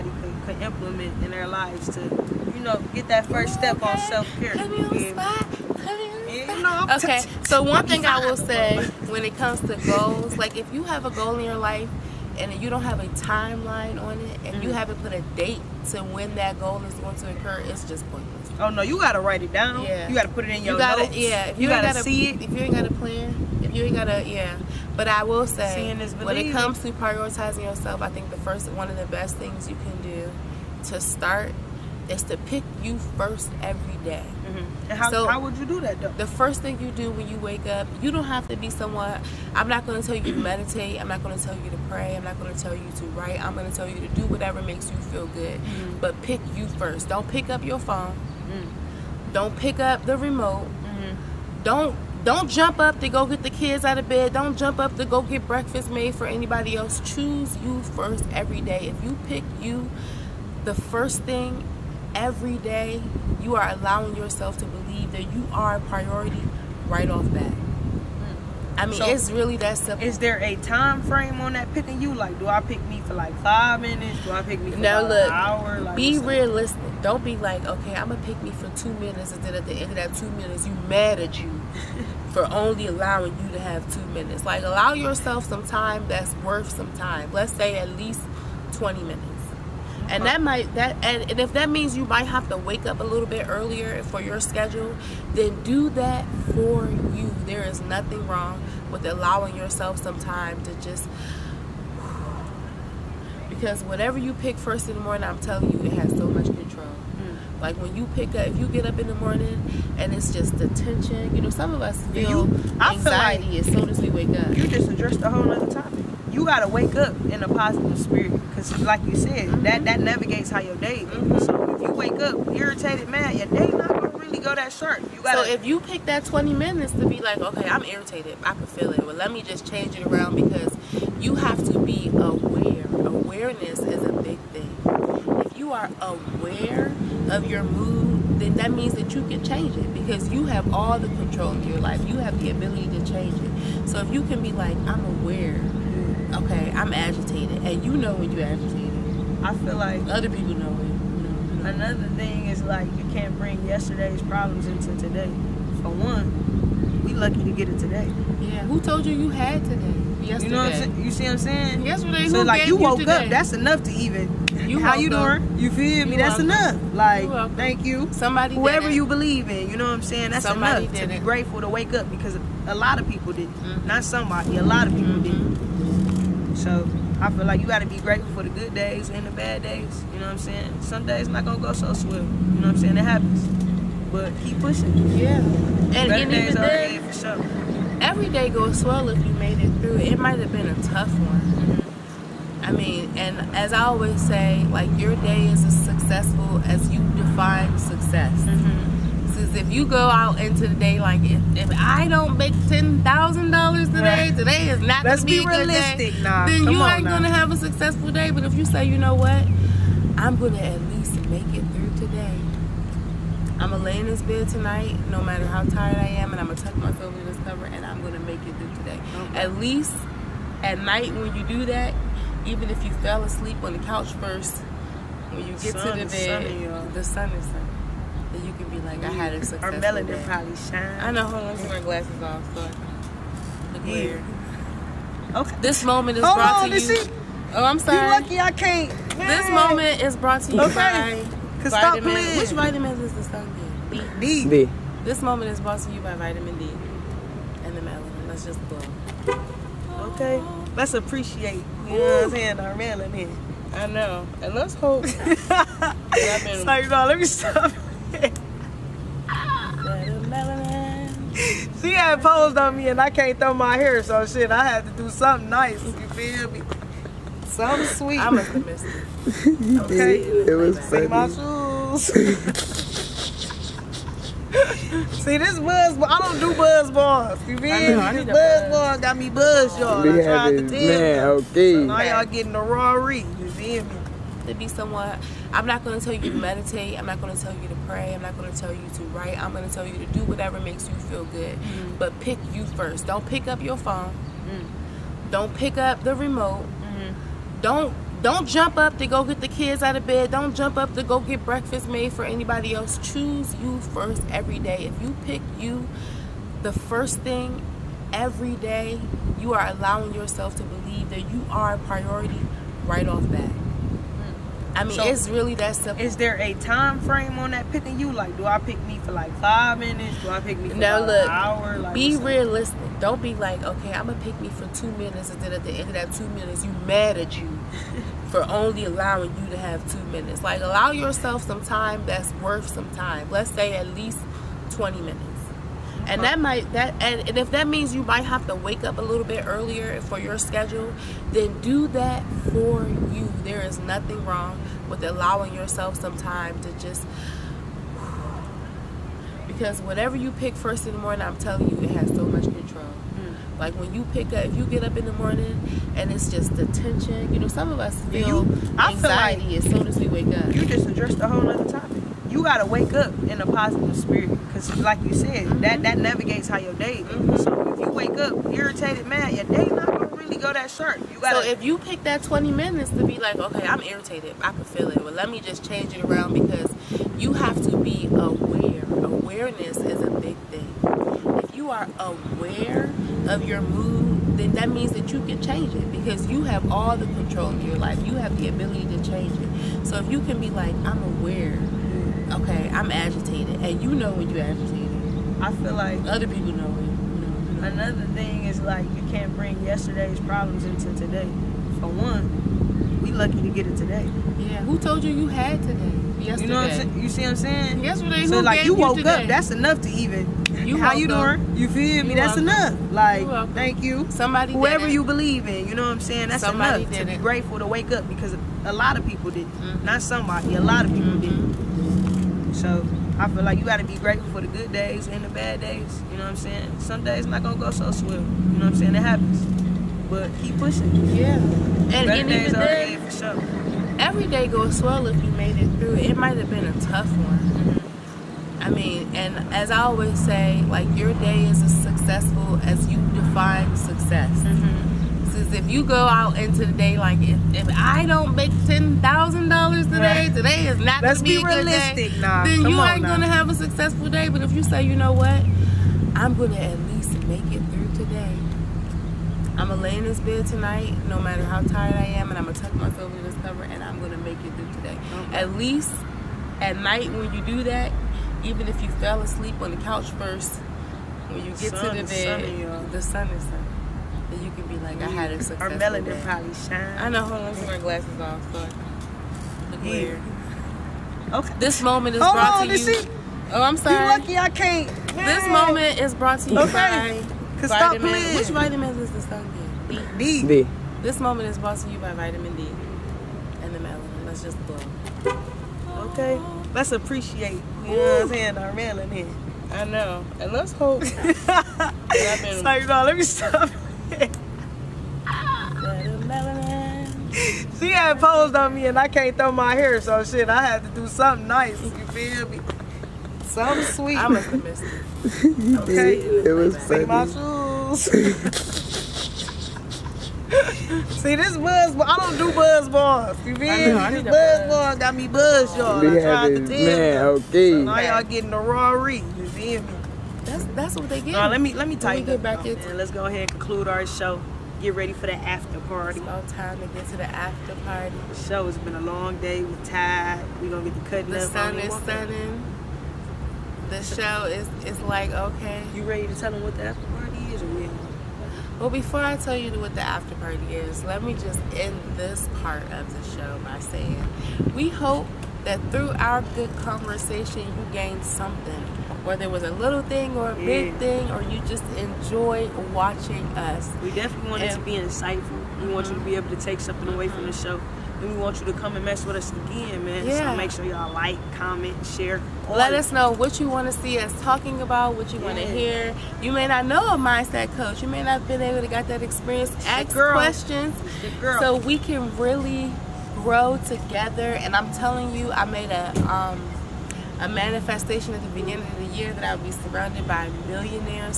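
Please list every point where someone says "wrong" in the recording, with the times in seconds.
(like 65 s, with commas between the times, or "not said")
98 s, 344 s.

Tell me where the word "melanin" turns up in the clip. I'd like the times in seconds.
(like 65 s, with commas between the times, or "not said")
229 s, 247 s, 252 s, 475 s, 493 s, 498 s.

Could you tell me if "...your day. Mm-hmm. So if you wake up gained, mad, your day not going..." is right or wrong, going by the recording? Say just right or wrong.
wrong.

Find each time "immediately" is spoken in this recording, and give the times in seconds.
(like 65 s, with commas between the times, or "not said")
not said.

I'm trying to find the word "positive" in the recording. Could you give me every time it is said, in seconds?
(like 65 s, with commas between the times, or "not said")
117 s, 363 s.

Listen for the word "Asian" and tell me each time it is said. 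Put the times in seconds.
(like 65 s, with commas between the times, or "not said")
not said.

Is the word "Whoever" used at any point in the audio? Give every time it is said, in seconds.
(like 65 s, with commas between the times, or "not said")
168 s, 414 s.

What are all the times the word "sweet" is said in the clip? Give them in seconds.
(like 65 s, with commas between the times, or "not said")
267 s, 513 s.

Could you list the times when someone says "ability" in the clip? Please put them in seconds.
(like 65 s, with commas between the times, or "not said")
142 s, 388 s.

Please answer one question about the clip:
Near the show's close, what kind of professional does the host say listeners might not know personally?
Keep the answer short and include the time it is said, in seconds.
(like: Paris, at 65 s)
mindset coach, at 577 s.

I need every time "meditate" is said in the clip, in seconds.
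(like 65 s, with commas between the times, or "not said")
40 s, 286 s.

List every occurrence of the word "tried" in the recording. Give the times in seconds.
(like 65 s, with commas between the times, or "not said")
280 s, 526 s.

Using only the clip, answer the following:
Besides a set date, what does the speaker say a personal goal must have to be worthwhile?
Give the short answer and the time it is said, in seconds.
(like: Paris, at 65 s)
timeline, at 13 s.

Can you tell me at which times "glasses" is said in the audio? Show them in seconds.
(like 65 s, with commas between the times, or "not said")
231 s, 477 s.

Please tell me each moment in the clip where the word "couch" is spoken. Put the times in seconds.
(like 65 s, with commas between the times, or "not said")
223 s, 469 s.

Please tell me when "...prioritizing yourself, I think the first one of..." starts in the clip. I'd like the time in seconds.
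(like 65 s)
26 s.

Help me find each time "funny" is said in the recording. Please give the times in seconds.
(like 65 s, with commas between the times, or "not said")
270 s, 516 s.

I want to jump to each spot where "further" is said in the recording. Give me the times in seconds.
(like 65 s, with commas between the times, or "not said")
not said.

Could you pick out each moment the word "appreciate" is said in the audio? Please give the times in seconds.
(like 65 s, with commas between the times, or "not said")
250 s, 496 s.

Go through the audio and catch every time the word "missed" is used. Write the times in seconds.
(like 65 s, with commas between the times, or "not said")
268 s, 514 s.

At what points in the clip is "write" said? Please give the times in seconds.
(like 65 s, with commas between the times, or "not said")
19 s, 43 s, 289 s.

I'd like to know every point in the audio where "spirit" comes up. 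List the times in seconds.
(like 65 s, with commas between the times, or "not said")
117 s, 363 s.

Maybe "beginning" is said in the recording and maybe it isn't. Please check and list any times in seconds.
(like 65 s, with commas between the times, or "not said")
588 s.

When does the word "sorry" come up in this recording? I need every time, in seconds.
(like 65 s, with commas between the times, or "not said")
237 s, 483 s.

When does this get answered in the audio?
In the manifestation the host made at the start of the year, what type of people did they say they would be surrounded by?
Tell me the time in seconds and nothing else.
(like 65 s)
590 s.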